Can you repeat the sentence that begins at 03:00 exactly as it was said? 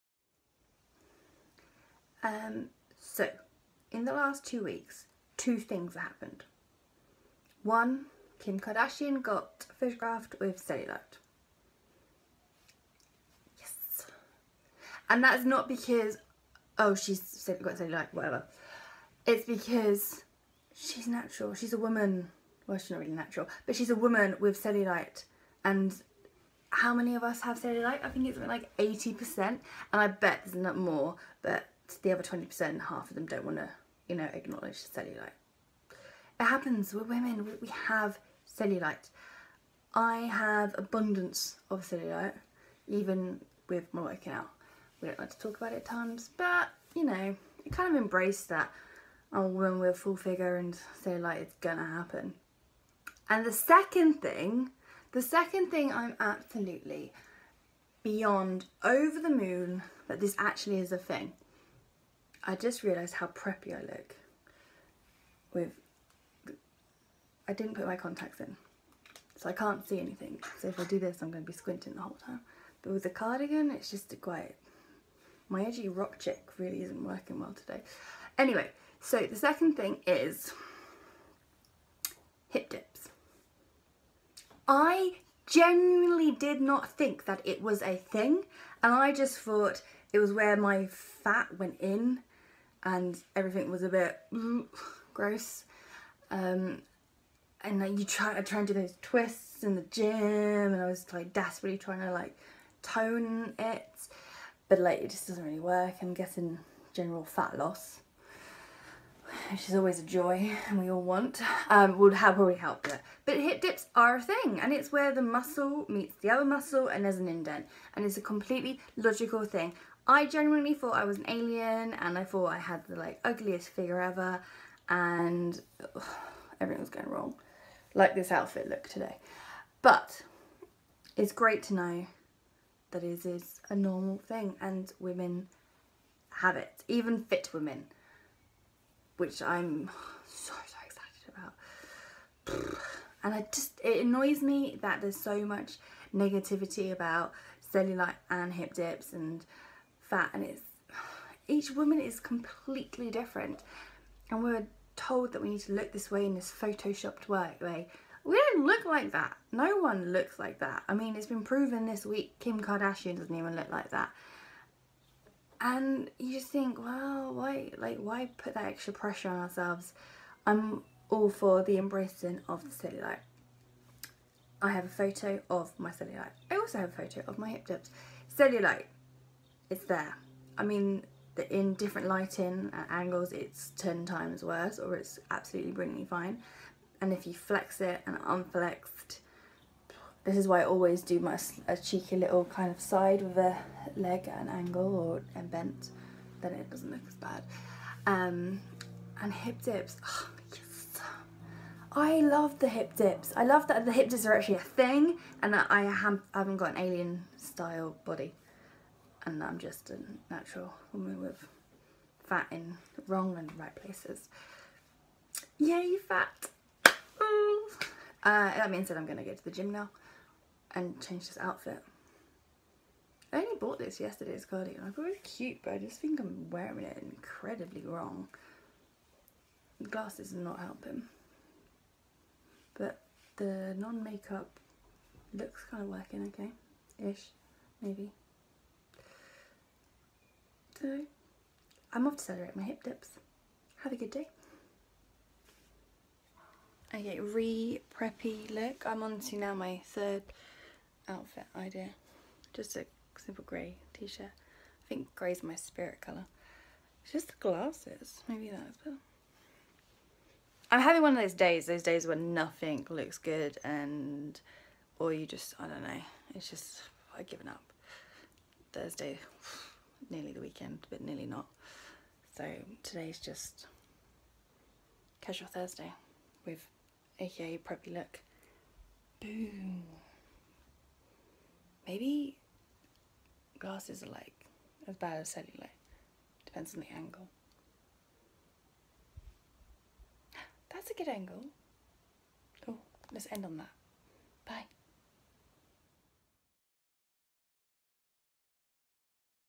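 I mean, in different lighting and uh, angles it's 10 times worse or it's absolutely brilliantly fine.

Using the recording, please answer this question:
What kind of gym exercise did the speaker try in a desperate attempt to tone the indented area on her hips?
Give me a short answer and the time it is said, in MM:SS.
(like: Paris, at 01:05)
twists, at 01:39.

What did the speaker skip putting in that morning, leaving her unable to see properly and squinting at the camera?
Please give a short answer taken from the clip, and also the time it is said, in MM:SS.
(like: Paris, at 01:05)
contacts, at 01:07.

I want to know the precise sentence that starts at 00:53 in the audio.
And the second thing, the second thing I'm absolutely beyond over the moon that this actually is a thing.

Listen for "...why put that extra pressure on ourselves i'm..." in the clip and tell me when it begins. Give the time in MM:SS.
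02:47.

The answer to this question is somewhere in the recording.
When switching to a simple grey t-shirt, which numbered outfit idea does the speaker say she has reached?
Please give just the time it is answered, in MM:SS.
04:09.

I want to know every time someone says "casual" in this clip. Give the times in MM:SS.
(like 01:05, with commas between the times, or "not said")
04:35.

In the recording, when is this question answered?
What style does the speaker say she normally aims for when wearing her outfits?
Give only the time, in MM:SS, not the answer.
01:15.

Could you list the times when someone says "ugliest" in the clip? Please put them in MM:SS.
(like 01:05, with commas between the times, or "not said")
02:03.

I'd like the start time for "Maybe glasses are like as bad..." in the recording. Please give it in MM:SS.
04:41.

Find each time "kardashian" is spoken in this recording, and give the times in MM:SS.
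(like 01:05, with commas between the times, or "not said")
00:08, 02:42.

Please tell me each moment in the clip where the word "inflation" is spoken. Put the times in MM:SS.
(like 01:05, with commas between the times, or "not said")
not said.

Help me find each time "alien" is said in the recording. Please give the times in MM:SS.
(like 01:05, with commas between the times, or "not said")
02:01, 03:26.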